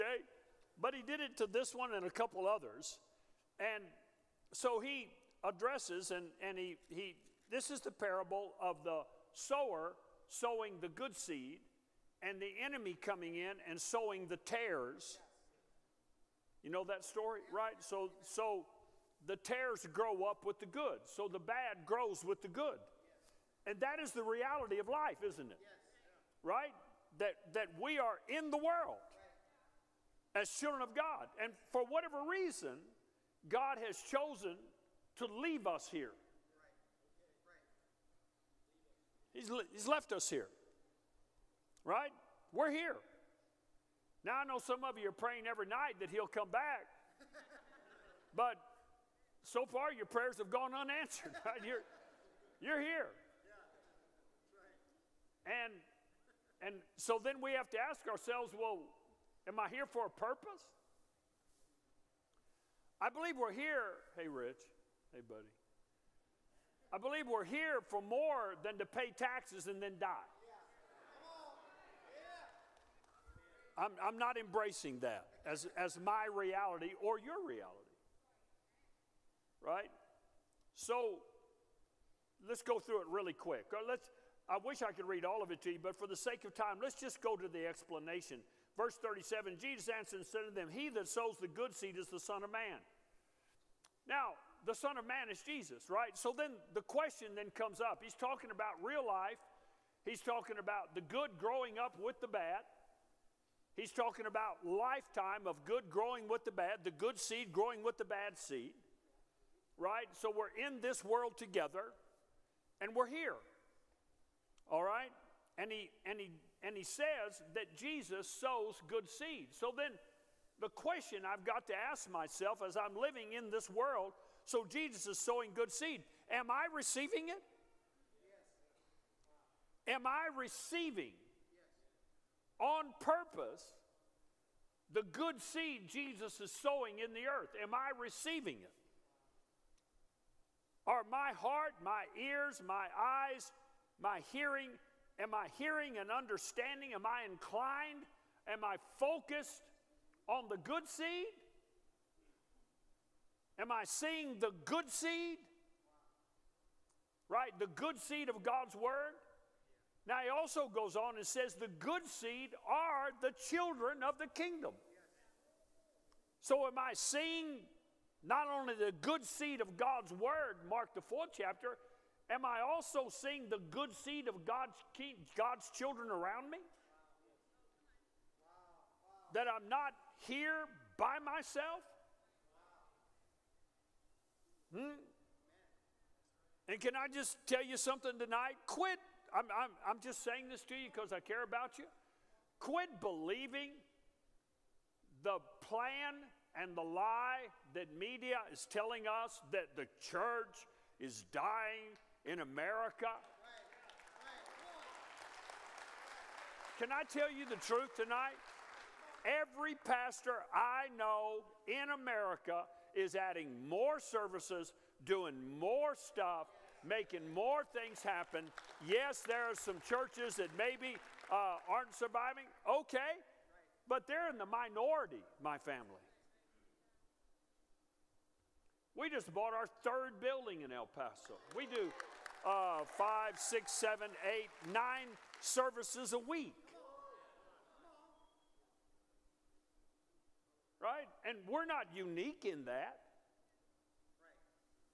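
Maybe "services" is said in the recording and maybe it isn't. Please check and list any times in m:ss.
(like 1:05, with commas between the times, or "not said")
3:33, 3:55.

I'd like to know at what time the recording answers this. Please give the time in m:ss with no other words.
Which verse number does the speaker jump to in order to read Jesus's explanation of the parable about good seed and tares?
1:28.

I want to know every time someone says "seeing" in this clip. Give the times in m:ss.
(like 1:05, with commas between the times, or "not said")
2:33, 2:46, 2:53.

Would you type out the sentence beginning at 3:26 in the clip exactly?
Can I tell you the truth tonight?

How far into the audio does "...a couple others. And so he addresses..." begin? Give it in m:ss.
0:02.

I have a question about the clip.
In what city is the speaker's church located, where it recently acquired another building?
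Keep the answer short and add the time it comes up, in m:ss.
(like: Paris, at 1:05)
El Paso, at 3:50.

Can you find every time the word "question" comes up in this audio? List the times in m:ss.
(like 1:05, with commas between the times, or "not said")
1:36, 2:00.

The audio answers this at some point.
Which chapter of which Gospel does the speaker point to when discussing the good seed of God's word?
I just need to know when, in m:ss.
2:50.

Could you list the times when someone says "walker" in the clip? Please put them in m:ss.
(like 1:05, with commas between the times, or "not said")
not said.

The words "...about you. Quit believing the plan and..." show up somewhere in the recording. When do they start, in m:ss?
3:11.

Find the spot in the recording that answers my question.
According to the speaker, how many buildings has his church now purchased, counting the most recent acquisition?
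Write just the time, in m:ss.
3:49.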